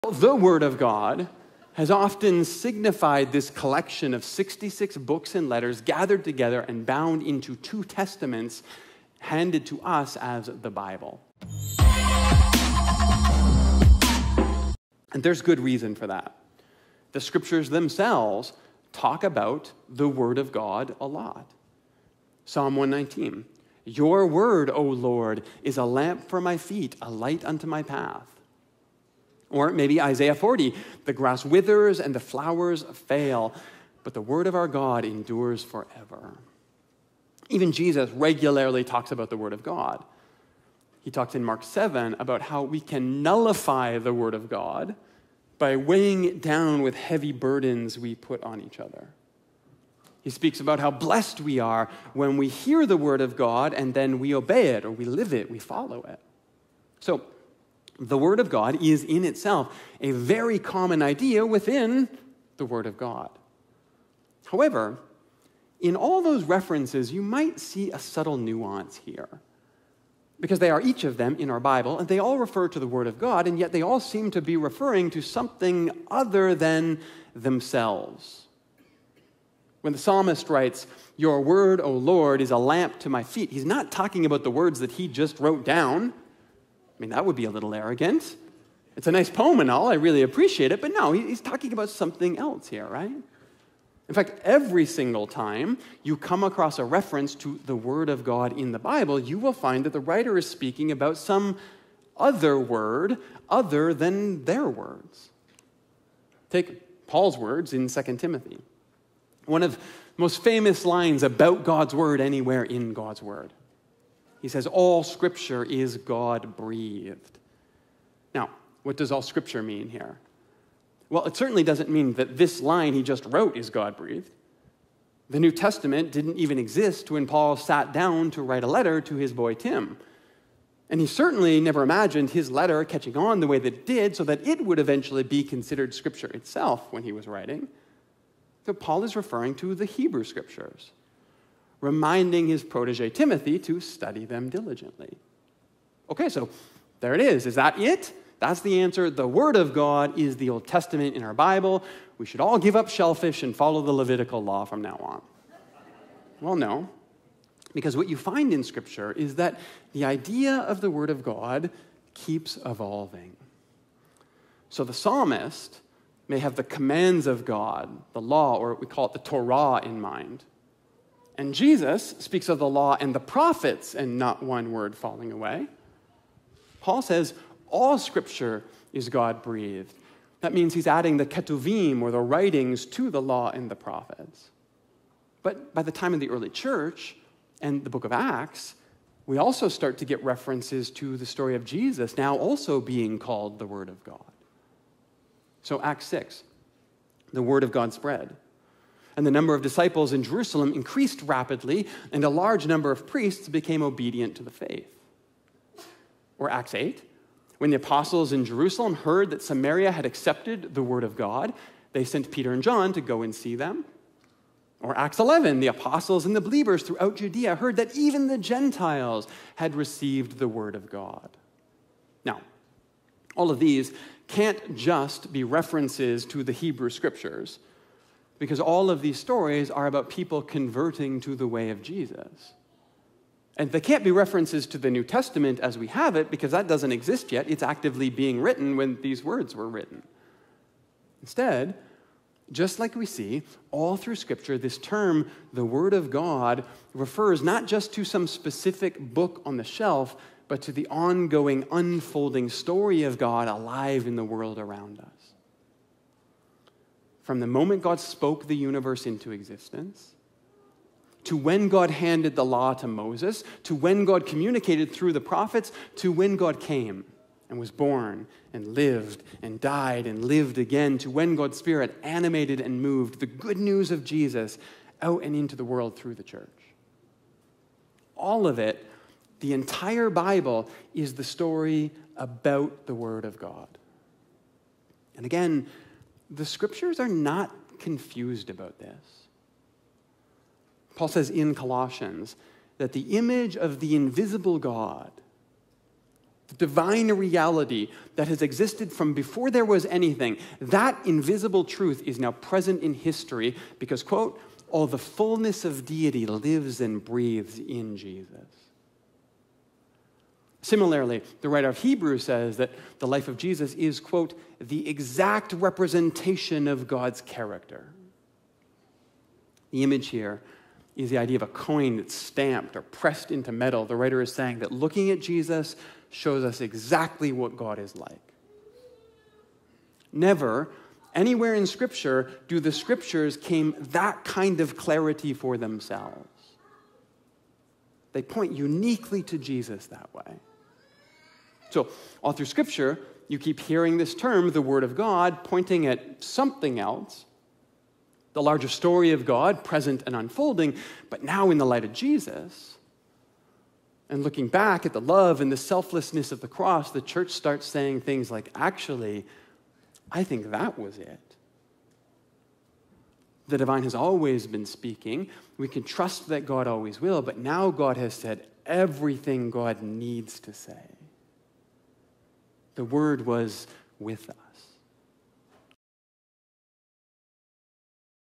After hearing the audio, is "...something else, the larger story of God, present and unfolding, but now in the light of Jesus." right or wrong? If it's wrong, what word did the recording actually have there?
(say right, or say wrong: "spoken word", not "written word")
right.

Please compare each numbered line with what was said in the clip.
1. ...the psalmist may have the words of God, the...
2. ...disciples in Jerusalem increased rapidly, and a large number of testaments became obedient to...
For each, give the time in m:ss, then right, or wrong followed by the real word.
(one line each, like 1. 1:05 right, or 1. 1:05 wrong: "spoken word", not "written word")
1. 2:44 wrong: "commands", not "words"
2. 3:19 wrong: "priests", not "testaments".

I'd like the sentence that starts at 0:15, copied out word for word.
And there's good reason for that.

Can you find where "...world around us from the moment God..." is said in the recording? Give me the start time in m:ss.
4:14.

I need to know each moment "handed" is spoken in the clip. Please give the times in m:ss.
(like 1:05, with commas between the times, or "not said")
0:09, 4:21.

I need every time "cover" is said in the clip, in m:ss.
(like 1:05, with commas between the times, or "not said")
not said.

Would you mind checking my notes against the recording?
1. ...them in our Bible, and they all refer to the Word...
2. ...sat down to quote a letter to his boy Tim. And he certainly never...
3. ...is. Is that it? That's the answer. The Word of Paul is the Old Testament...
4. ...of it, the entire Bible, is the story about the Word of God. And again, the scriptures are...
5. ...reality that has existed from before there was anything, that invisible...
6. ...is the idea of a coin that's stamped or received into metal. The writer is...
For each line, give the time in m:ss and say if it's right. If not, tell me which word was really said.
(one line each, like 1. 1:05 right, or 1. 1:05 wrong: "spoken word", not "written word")
1. 1:11 right
2. 2:07 wrong: "write", not "quote"
3. 2:27 wrong: "God", not "Paul"
4. 4:38 right
5. 4:57 right
6. 5:20 wrong: "pressed", not "received".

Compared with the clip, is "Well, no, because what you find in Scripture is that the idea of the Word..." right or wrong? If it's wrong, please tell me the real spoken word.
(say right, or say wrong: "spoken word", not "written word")
right.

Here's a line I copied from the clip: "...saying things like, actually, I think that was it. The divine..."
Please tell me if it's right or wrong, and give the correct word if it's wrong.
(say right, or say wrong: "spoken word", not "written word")
right.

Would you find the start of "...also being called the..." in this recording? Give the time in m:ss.
3:12.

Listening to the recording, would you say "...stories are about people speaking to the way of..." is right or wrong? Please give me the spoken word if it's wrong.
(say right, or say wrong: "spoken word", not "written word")
wrong: "converting", not "speaking".